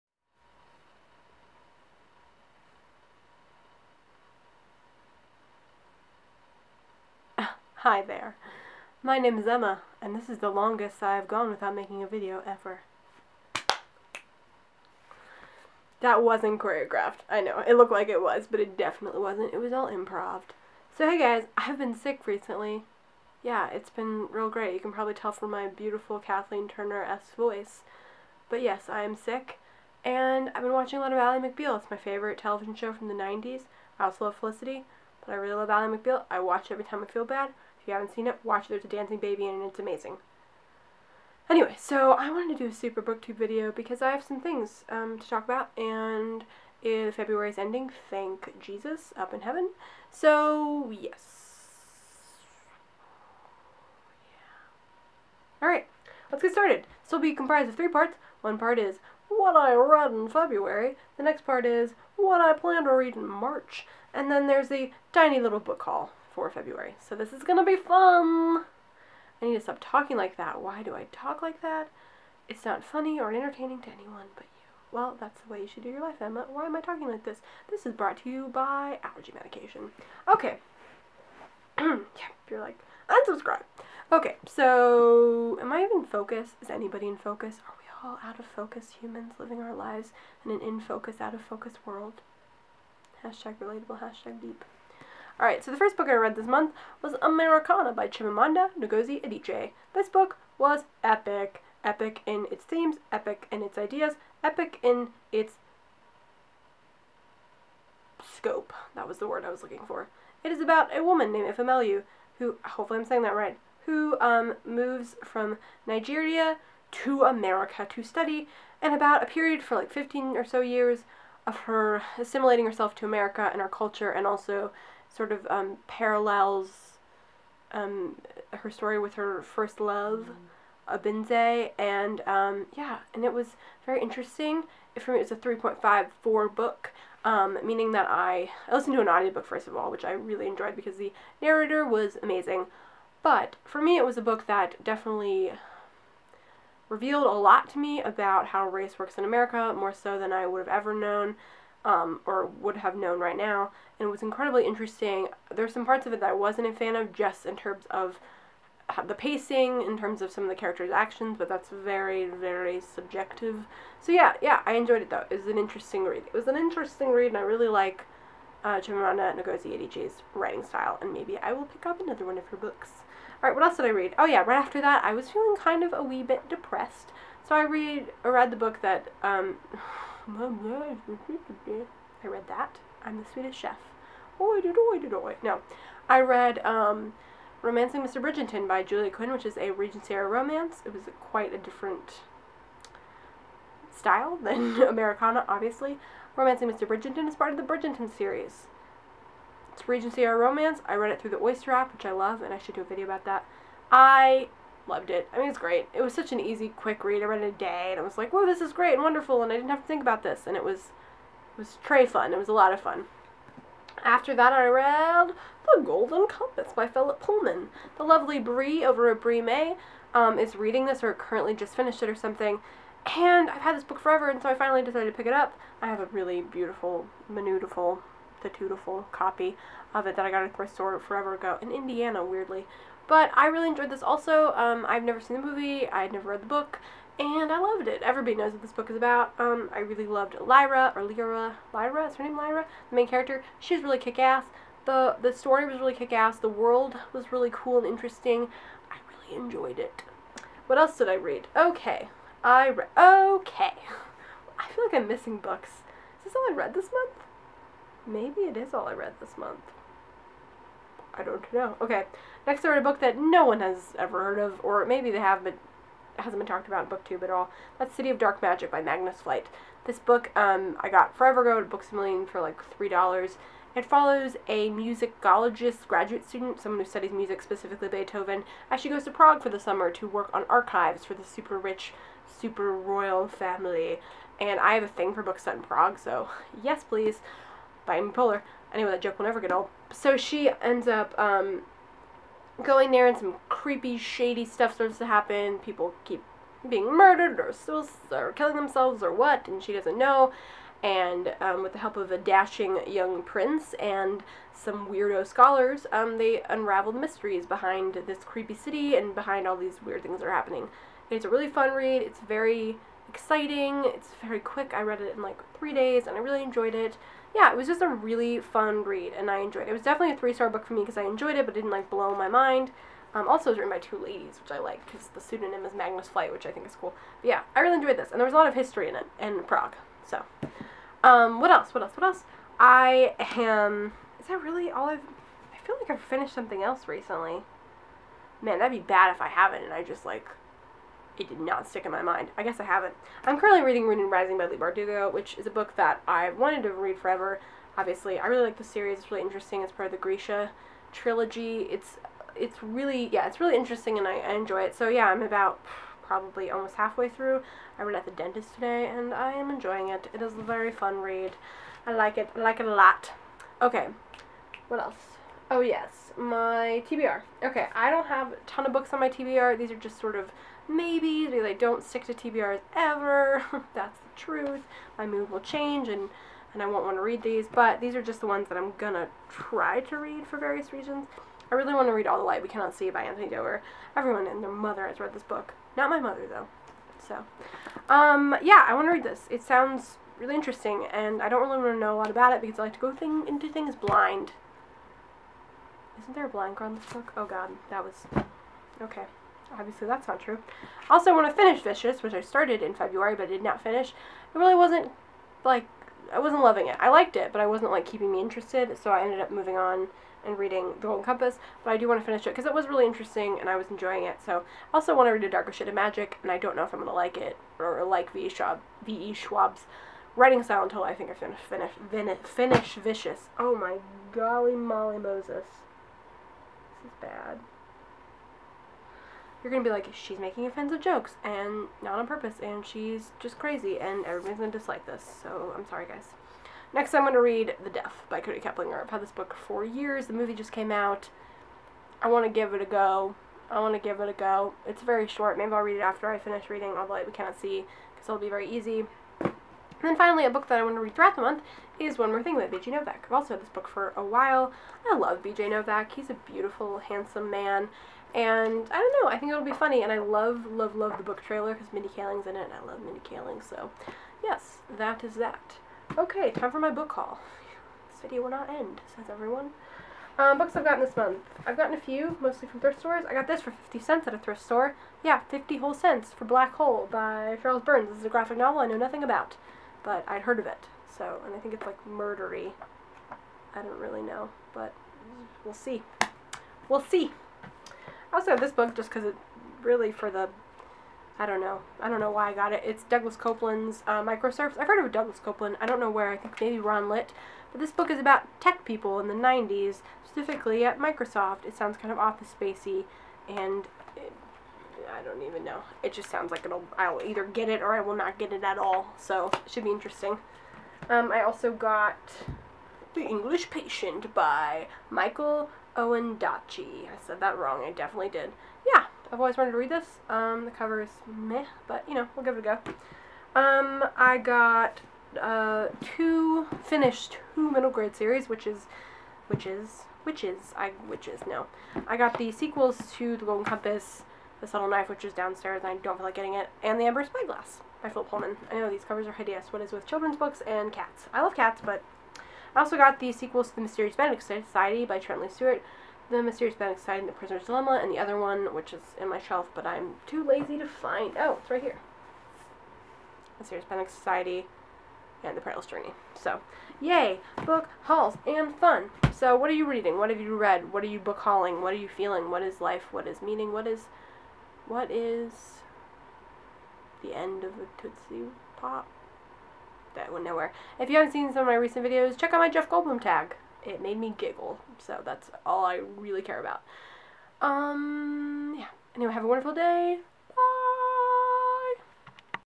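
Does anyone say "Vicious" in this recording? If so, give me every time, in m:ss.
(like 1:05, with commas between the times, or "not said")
6:41, 7:02.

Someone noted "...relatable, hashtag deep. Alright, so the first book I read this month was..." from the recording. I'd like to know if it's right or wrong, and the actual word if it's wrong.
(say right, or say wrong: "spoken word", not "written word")
right.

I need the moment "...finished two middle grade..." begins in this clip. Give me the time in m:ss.
8:46.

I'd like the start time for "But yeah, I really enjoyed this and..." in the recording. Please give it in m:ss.
5:27.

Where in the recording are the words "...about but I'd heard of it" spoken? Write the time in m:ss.
7:59.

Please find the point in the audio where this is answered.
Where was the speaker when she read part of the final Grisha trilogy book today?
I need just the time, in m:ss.
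5:58.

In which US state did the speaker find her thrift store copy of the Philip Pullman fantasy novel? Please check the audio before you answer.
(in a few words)
Indiana.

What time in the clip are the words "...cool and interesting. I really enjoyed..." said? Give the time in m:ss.
4:07.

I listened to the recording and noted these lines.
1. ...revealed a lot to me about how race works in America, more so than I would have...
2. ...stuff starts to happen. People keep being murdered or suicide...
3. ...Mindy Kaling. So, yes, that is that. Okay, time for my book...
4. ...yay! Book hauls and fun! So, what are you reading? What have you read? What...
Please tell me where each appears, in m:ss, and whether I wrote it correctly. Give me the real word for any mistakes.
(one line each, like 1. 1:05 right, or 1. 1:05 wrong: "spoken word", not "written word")
1. 2:26 right
2. 4:54 right
3. 7:42 right
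4. 9:16 right.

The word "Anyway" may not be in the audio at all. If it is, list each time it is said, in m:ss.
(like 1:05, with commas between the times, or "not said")
0:41, 4:48, 9:38.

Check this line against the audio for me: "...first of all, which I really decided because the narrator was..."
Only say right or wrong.
wrong.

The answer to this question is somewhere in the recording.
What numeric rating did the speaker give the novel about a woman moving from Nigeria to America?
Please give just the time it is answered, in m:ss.
2:15.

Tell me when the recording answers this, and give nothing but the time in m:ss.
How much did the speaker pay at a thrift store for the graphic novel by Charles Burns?
7:53.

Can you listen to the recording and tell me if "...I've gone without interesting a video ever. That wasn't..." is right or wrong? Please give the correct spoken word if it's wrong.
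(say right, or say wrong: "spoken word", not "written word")
wrong: "making", not "interesting".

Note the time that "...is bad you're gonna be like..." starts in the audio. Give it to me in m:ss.
7:06.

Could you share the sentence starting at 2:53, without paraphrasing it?
Alright, what else did I read?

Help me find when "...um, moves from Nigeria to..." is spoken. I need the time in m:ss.
1:54.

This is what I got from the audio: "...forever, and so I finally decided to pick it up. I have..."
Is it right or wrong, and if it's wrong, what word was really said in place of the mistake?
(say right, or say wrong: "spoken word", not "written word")
right.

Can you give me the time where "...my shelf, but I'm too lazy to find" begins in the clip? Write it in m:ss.
9:09.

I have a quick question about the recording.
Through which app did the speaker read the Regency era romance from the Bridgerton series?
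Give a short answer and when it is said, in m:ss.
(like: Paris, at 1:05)
Oyster, at 3:21.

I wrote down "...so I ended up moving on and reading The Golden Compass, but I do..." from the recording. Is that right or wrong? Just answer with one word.
right.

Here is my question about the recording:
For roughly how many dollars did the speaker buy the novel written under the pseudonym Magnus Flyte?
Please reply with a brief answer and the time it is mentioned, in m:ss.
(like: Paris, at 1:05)
3, at 4:32.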